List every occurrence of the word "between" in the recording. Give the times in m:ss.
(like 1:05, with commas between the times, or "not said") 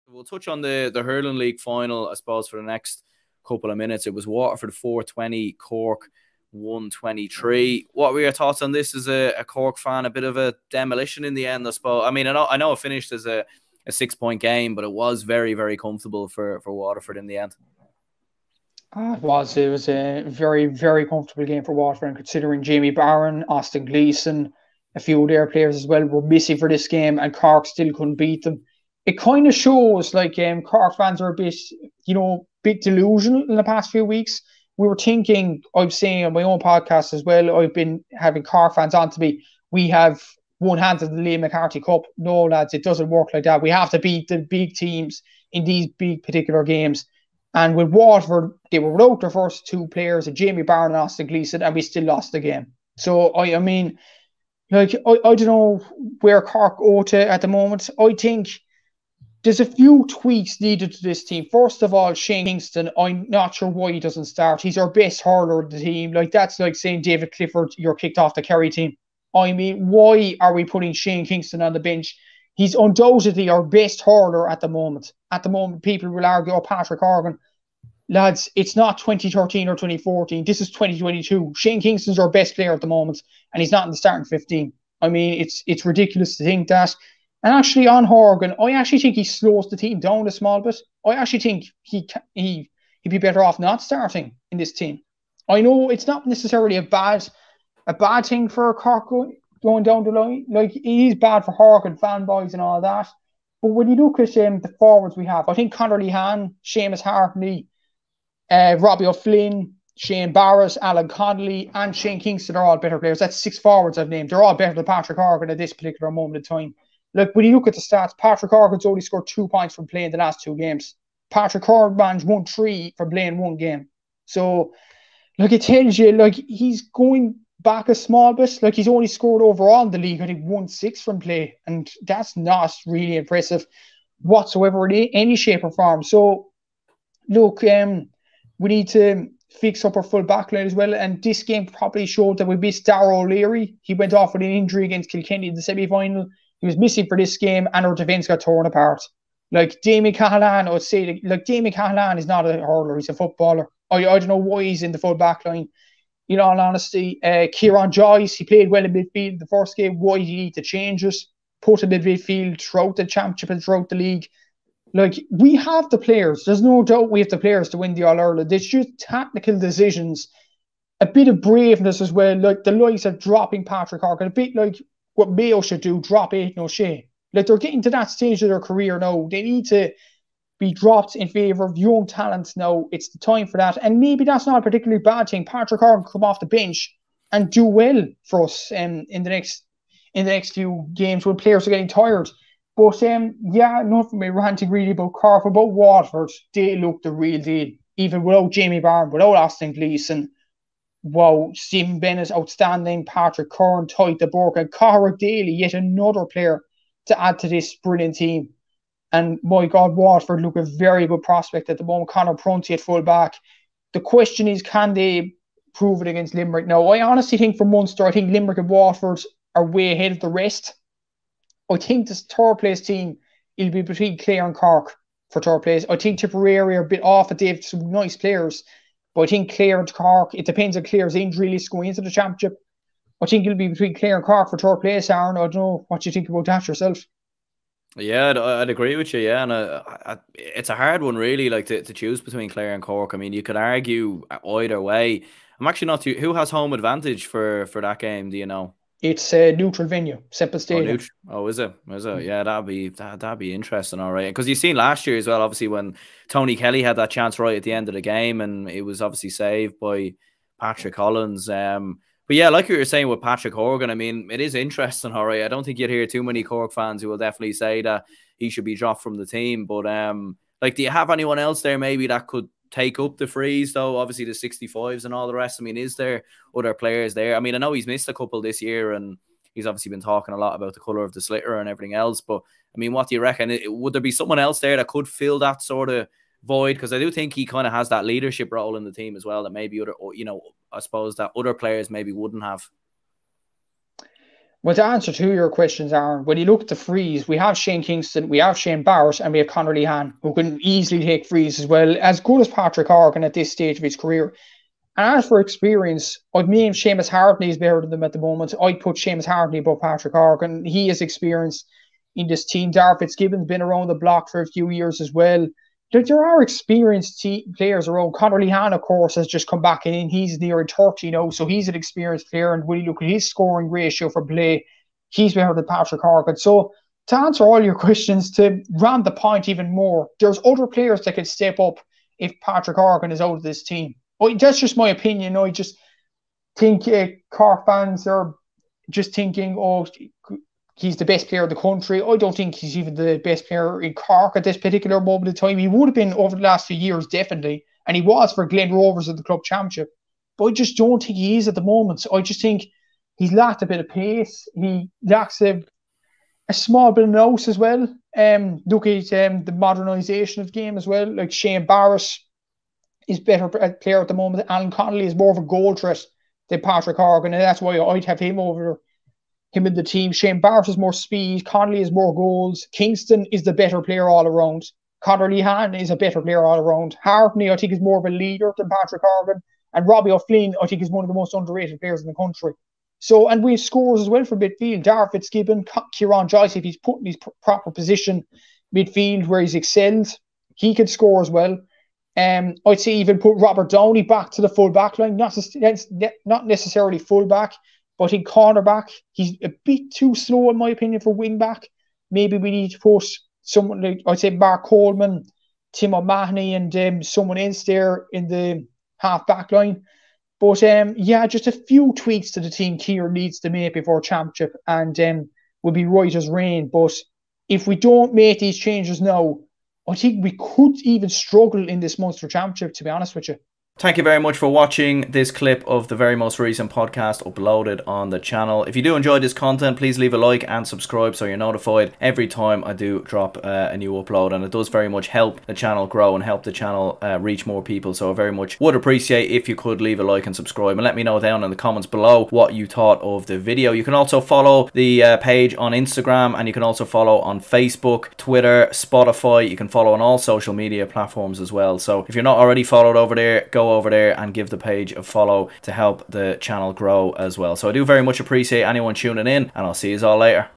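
3:43, 3:53, 4:02.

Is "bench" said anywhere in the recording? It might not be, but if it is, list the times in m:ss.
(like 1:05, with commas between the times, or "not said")
1:11, 3:06.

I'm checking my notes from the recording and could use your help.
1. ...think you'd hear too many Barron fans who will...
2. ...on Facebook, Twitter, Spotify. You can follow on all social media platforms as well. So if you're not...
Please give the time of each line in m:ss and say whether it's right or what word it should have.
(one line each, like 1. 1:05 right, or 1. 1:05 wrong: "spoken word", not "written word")
1. 4:25 wrong: "Cork", not "Barron"
2. 7:27 right.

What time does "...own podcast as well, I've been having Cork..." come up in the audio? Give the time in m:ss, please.
0:36.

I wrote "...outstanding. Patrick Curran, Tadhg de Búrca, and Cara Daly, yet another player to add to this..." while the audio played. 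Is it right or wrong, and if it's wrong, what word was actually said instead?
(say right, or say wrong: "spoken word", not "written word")
right.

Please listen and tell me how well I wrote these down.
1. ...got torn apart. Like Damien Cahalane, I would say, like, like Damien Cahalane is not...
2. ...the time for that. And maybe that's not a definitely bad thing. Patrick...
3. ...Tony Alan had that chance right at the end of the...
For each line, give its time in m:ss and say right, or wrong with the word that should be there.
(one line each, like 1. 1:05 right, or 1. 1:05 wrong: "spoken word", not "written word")
1. 2:28 right
2. 3:03 wrong: "particularly", not "definitely"
3. 4:16 wrong: "Kelly", not "Alan".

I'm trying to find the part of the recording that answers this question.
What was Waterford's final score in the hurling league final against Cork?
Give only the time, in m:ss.
0:04.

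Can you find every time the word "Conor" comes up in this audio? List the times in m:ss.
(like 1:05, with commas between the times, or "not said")
1:45, 3:32, 4:59, 5:18, 6:15.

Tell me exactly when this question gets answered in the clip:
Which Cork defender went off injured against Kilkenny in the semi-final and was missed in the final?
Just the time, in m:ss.
2:22.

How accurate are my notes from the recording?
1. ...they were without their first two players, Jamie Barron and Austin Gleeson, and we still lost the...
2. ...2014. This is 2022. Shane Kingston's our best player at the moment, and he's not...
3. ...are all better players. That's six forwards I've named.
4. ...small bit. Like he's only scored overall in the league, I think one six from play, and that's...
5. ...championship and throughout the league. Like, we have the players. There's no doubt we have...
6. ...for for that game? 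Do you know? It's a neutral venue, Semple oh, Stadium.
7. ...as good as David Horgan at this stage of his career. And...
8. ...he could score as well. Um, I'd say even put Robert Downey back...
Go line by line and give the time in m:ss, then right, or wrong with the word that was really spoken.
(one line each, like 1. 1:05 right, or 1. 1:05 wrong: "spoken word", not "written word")
1. 0:48 right
2. 1:19 right
3. 1:52 right
4. 2:07 right
5. 2:43 right
6. 4:07 right
7. 5:01 wrong: "Patrick", not "David"
8. 6:30 right.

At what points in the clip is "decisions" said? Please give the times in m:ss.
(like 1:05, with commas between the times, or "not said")
2:49.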